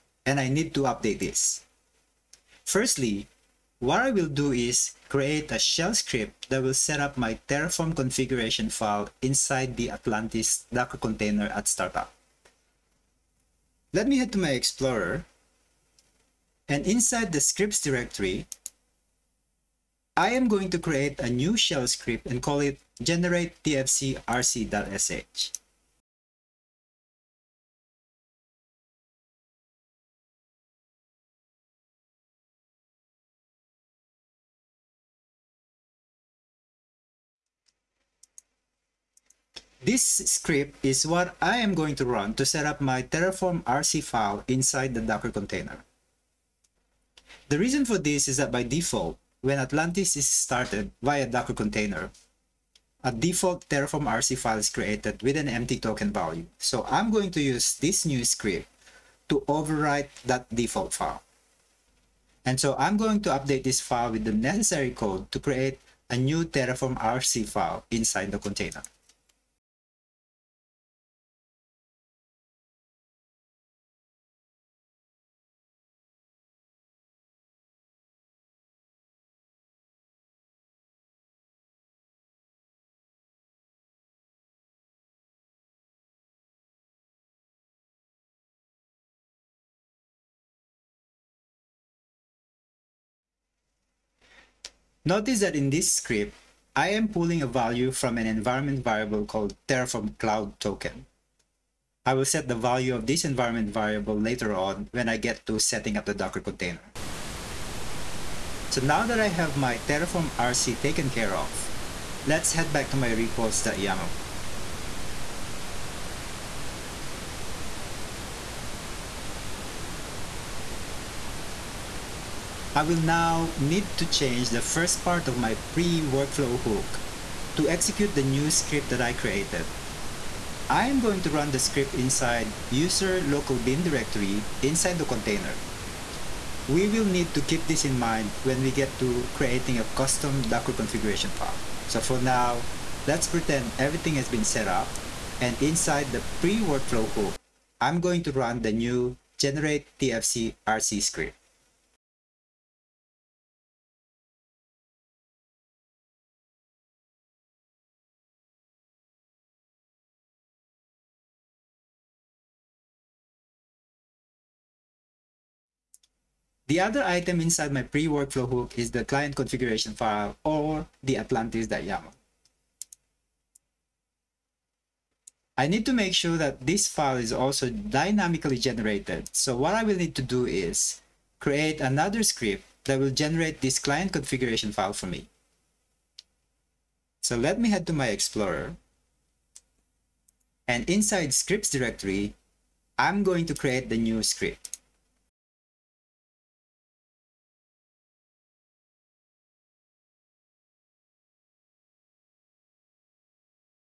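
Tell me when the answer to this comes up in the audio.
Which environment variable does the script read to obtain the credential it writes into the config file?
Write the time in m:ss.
1:39.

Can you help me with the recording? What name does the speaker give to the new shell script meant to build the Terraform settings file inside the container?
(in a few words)
generate tfcrc.sh.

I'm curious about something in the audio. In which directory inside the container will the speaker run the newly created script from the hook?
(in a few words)
user local bin.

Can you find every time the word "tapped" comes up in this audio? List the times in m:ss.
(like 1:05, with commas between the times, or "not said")
not said.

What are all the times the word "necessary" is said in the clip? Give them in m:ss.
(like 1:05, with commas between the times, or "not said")
1:04.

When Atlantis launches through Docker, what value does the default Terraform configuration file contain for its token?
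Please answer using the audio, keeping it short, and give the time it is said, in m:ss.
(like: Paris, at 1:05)
empty, at 0:55.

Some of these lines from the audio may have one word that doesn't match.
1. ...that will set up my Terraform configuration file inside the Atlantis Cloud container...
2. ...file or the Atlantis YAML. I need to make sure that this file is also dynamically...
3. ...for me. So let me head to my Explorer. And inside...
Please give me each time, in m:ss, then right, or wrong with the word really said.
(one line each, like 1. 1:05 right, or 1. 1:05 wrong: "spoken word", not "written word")
1. 0:06 wrong: "Docker", not "Cloud"
2. 2:49 right
3. 3:04 right.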